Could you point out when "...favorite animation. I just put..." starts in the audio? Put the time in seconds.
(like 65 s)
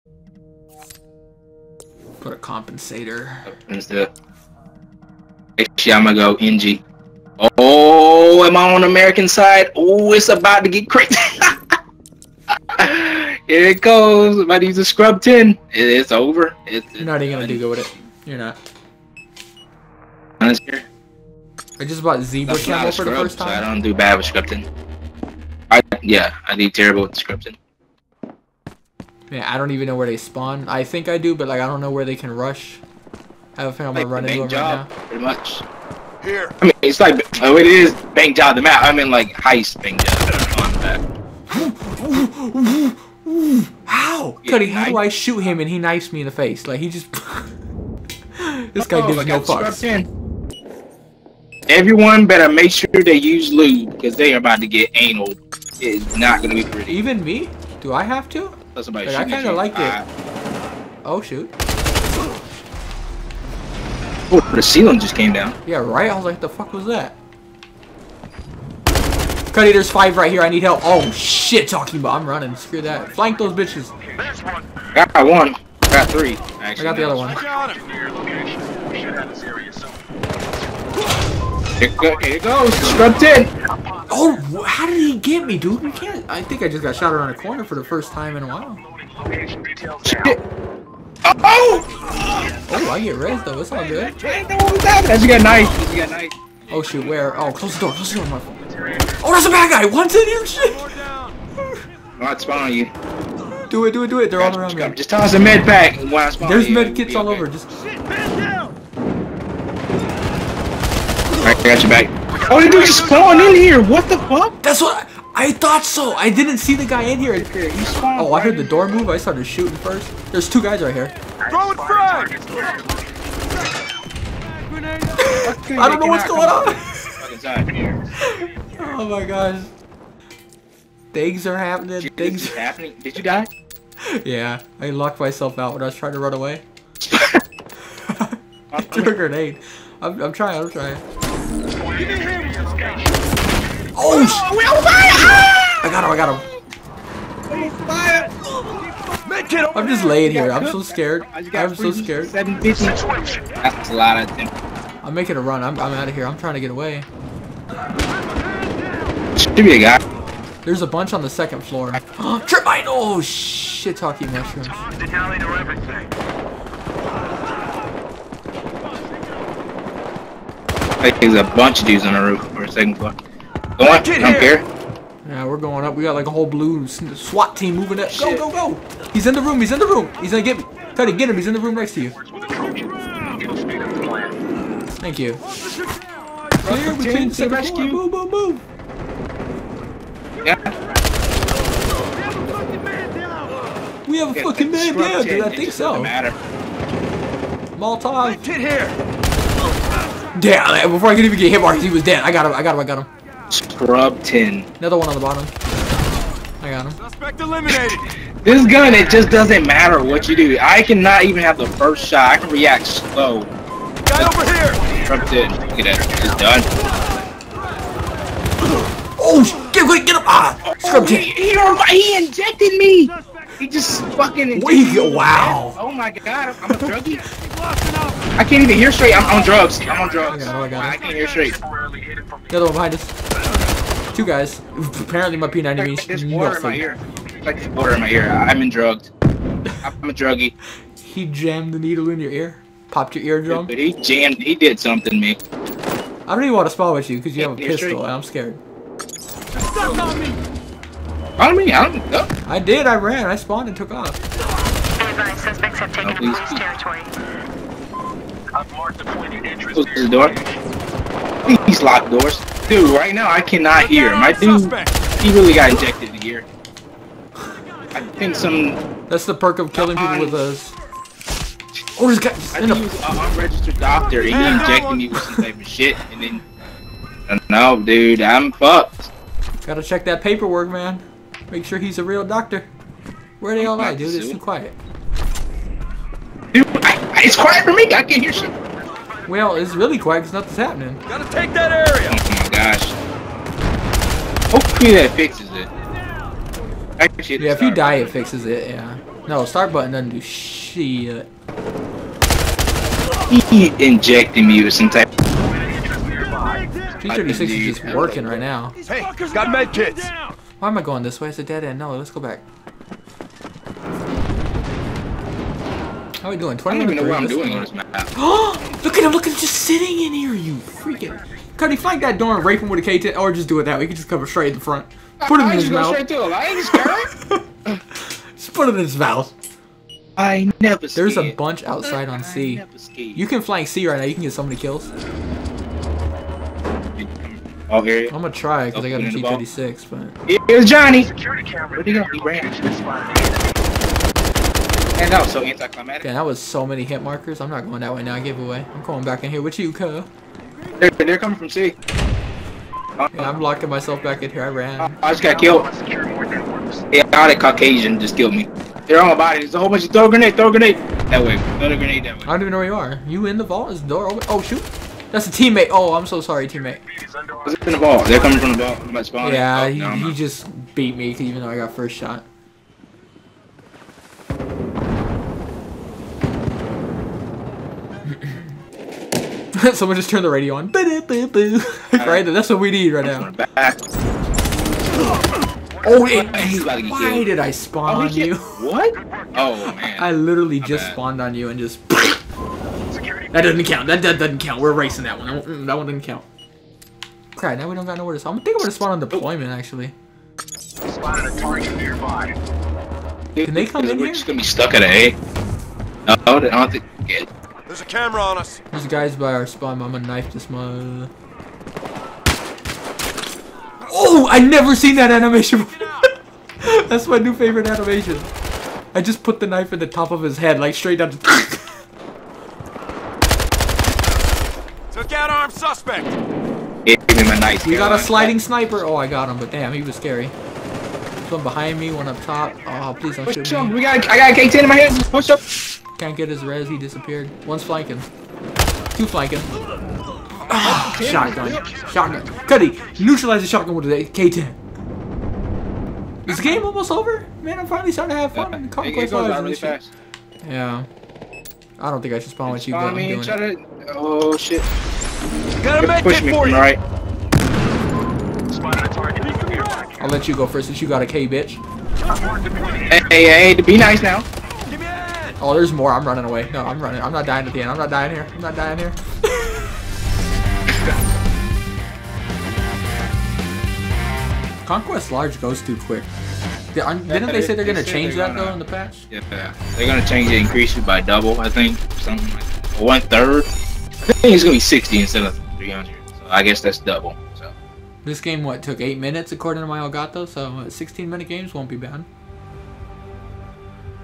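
417 s.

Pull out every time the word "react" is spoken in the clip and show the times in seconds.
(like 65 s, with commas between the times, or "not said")
212 s.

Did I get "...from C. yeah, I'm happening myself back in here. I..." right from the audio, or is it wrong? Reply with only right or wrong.
wrong.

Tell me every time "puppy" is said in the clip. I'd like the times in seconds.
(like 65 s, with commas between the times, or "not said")
not said.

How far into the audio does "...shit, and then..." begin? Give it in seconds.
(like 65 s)
275 s.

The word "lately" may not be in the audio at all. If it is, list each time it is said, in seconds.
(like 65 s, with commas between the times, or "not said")
not said.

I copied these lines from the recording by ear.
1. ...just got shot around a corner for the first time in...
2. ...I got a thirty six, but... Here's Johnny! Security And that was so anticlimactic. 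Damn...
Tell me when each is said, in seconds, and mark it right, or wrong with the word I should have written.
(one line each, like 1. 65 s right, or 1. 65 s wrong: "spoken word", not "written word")
1. 86 s right
2. 338 s right.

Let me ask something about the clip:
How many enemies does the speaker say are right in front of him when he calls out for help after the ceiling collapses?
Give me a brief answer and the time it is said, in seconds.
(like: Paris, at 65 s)
5, at 69 s.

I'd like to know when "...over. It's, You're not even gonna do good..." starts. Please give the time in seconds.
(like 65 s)
16 s.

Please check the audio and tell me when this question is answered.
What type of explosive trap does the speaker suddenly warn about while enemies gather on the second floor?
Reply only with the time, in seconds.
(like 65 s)
161 s.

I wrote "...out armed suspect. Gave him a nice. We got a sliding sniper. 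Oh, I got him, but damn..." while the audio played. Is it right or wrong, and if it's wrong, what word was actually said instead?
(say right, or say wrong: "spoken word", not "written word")
right.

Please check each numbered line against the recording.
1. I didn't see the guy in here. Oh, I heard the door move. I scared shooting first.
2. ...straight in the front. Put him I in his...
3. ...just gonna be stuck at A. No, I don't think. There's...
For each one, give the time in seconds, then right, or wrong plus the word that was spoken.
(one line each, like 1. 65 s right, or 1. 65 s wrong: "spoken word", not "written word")
1. 116 s wrong: "started", not "scared"
2. 324 s right
3. 404 s right.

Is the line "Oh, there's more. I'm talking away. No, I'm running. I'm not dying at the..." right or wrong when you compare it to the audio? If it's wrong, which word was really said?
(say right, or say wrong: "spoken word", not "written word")
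wrong: "running", not "talking".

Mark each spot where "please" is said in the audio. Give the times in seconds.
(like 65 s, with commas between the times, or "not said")
432 s.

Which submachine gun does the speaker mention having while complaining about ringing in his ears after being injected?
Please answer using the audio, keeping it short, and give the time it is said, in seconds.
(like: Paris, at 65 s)
P90, at 235 s.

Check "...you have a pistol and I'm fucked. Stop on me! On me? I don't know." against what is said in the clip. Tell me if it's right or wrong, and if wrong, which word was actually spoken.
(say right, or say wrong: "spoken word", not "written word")
wrong: "scared", not "fucked".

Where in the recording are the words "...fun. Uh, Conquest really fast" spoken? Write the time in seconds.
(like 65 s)
448 s.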